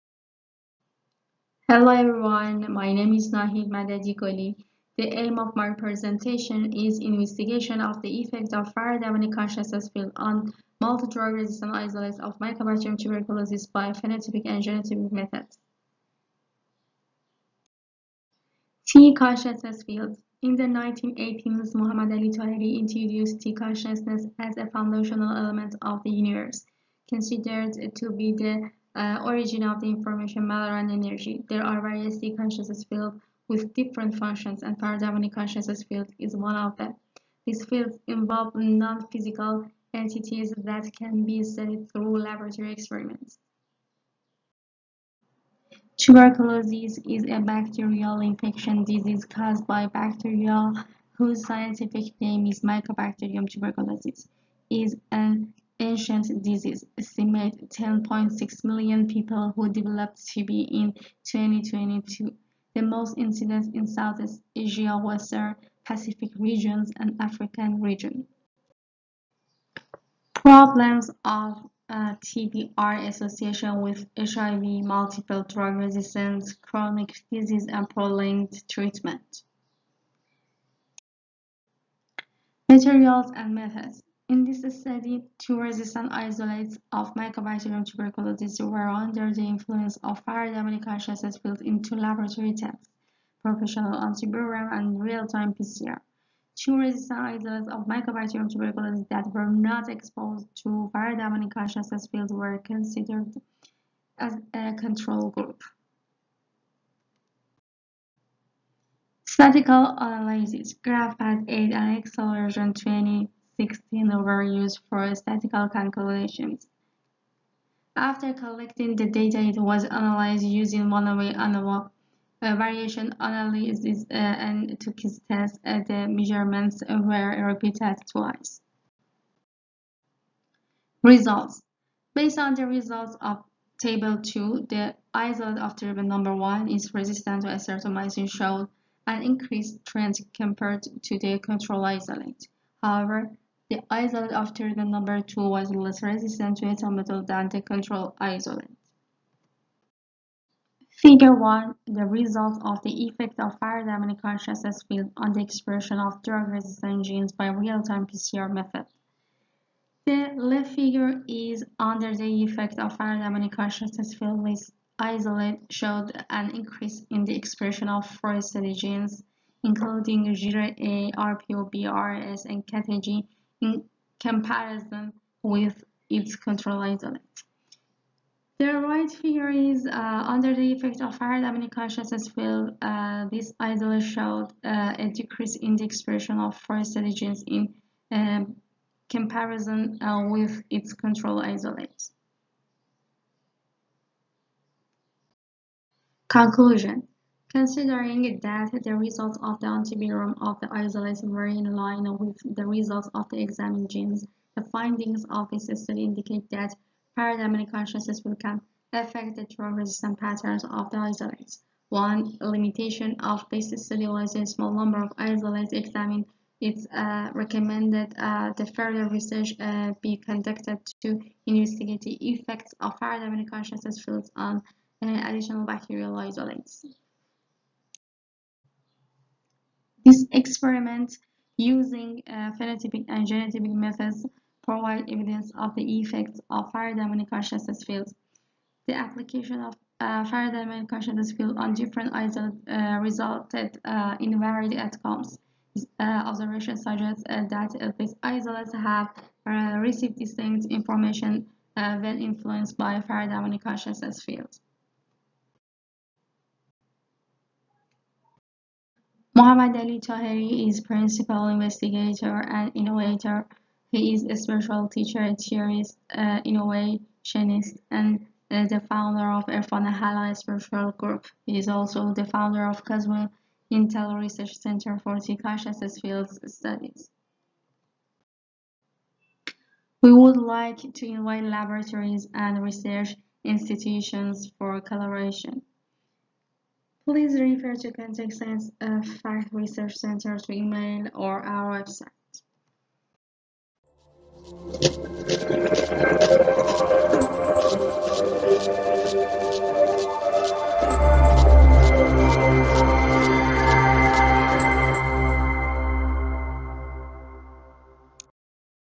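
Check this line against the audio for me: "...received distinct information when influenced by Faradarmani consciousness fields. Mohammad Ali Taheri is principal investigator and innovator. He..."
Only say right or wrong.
right.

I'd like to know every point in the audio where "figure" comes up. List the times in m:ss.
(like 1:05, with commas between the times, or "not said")
2:31, 2:40, 2:59.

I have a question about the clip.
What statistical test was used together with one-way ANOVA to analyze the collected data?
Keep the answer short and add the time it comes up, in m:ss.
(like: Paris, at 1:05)
Tukey's test, at 2:04.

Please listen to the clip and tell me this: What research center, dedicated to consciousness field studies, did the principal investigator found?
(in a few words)
Cosmo Intel Research Center.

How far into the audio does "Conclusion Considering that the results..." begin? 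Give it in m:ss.
3:16.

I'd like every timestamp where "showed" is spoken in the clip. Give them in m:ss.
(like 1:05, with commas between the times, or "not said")
2:18, 2:45, 3:04.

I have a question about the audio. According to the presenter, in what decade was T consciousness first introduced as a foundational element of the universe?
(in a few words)
1980s.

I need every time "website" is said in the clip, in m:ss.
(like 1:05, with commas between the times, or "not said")
4:51.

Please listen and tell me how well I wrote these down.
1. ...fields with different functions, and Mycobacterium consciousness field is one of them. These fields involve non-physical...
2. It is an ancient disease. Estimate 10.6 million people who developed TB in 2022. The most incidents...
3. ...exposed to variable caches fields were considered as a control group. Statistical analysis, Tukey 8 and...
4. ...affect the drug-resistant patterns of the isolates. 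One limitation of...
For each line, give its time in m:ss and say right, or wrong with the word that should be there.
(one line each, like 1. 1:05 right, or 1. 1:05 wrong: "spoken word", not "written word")
1. 0:32 wrong: "Faradarmani", not "Mycobacterium"
2. 0:54 right
3. 1:39 wrong: "GraphPad", not "Tukey"
4. 3:28 right.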